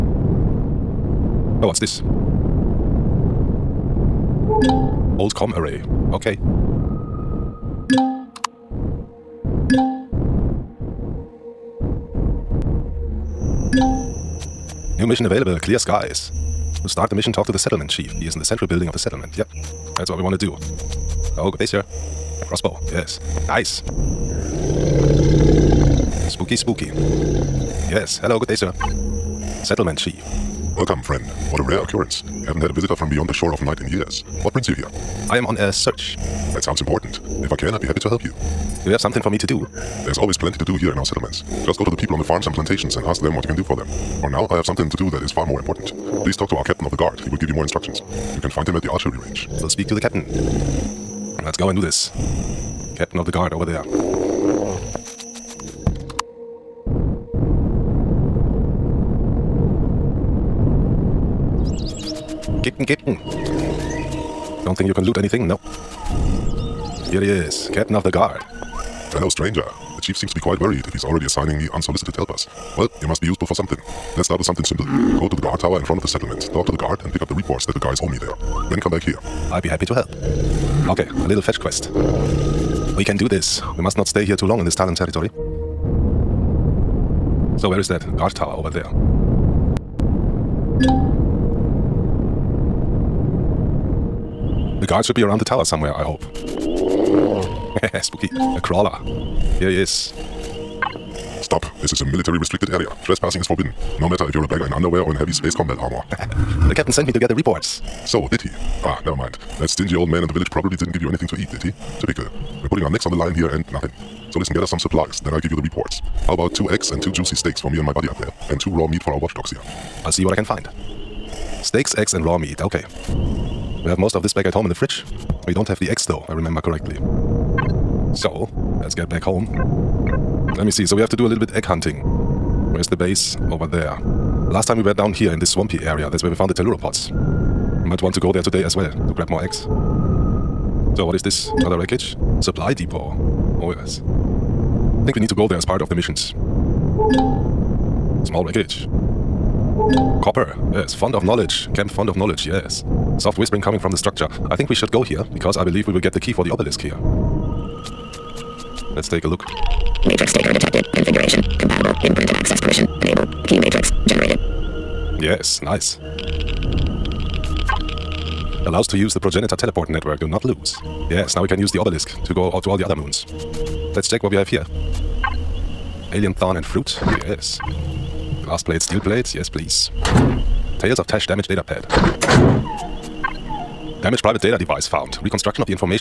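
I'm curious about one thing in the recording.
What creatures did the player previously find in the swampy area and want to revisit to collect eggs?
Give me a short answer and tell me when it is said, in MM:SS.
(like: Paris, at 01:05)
Telluropods, at 02:16.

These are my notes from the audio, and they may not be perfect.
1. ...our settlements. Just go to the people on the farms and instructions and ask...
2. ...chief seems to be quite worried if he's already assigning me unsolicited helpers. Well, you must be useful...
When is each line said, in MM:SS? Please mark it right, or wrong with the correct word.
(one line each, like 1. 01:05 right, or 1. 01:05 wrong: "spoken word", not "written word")
1. 00:40 wrong: "plantations", not "instructions"
2. 01:10 right.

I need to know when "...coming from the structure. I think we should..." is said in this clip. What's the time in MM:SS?
02:33.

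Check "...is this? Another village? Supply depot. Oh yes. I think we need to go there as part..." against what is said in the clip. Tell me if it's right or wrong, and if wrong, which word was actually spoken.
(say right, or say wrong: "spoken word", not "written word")
wrong: "wreckage", not "village".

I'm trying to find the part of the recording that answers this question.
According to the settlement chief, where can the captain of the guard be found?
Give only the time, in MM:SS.
00:48.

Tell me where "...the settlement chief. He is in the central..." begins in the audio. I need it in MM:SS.
00:17.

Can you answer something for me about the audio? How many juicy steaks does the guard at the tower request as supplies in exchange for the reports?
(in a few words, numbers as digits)
2.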